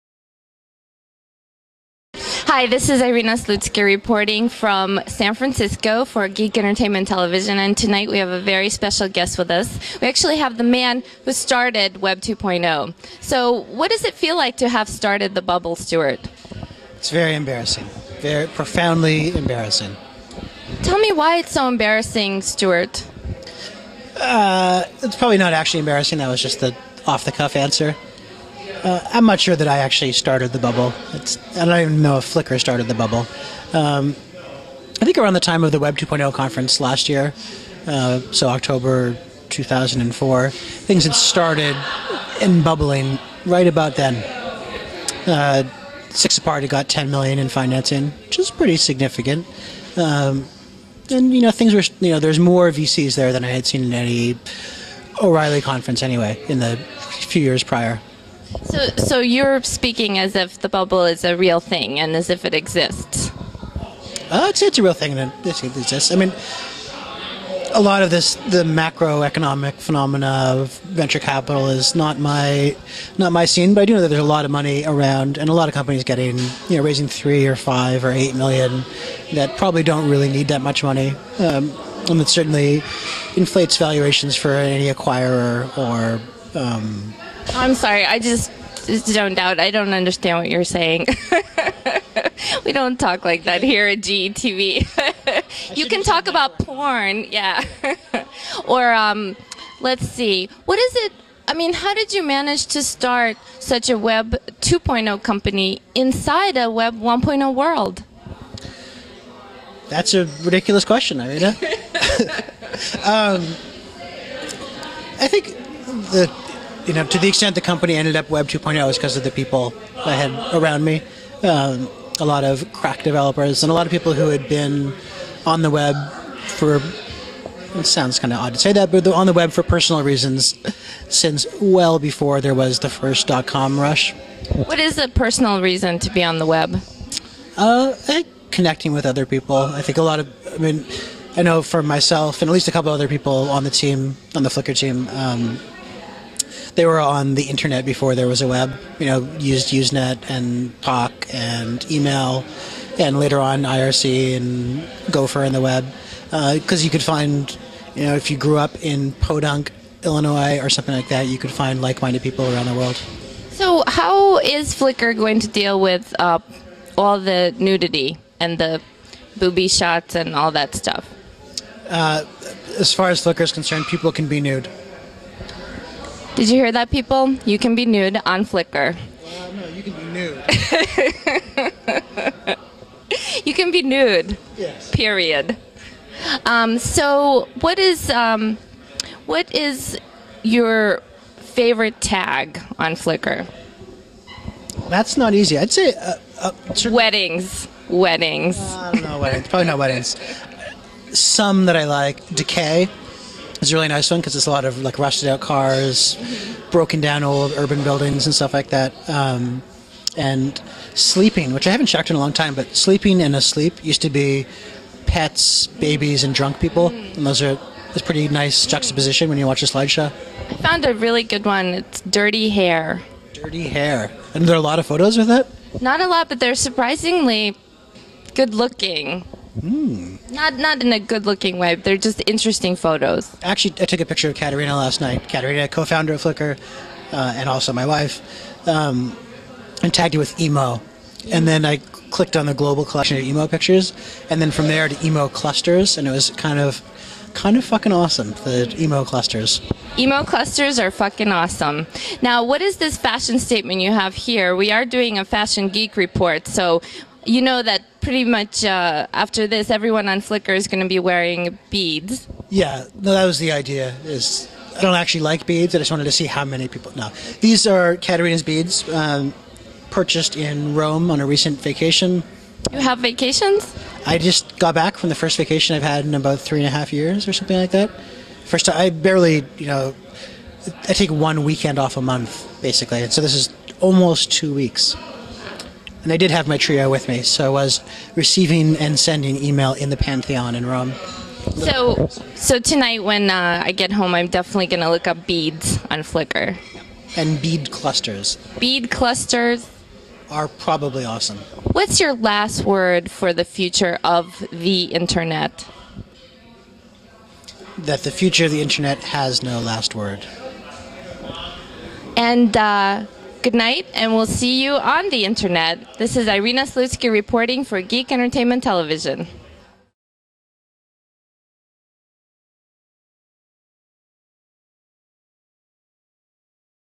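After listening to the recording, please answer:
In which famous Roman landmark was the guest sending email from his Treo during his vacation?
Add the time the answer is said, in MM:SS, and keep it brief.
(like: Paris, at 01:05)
the Pantheon, at 04:49.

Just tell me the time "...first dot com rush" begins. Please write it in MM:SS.
02:12.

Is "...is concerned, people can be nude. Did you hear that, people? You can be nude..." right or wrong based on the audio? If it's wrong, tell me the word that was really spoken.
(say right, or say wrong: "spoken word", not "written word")
right.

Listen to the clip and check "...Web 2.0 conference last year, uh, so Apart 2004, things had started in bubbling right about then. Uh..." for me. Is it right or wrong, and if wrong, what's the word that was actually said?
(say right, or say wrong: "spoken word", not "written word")
wrong: "October", not "Apart".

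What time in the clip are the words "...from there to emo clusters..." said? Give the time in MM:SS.
04:04.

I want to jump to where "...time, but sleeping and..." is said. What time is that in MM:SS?
03:32.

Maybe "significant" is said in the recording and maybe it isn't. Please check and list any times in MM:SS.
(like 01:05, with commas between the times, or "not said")
00:48.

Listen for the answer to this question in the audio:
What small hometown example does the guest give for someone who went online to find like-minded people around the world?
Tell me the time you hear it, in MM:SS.
02:39.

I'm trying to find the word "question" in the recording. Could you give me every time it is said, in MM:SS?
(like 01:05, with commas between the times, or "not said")
01:50.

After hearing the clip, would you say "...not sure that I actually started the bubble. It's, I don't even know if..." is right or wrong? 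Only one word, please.
right.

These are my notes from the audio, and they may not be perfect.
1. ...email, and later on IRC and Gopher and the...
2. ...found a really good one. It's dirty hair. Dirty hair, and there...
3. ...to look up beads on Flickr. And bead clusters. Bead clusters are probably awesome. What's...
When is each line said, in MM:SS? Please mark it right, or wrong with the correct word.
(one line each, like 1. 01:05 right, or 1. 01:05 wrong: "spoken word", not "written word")
1. 02:31 right
2. 03:40 right
3. 04:54 right.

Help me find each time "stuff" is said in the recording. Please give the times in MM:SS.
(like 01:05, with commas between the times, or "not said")
02:50, 03:28.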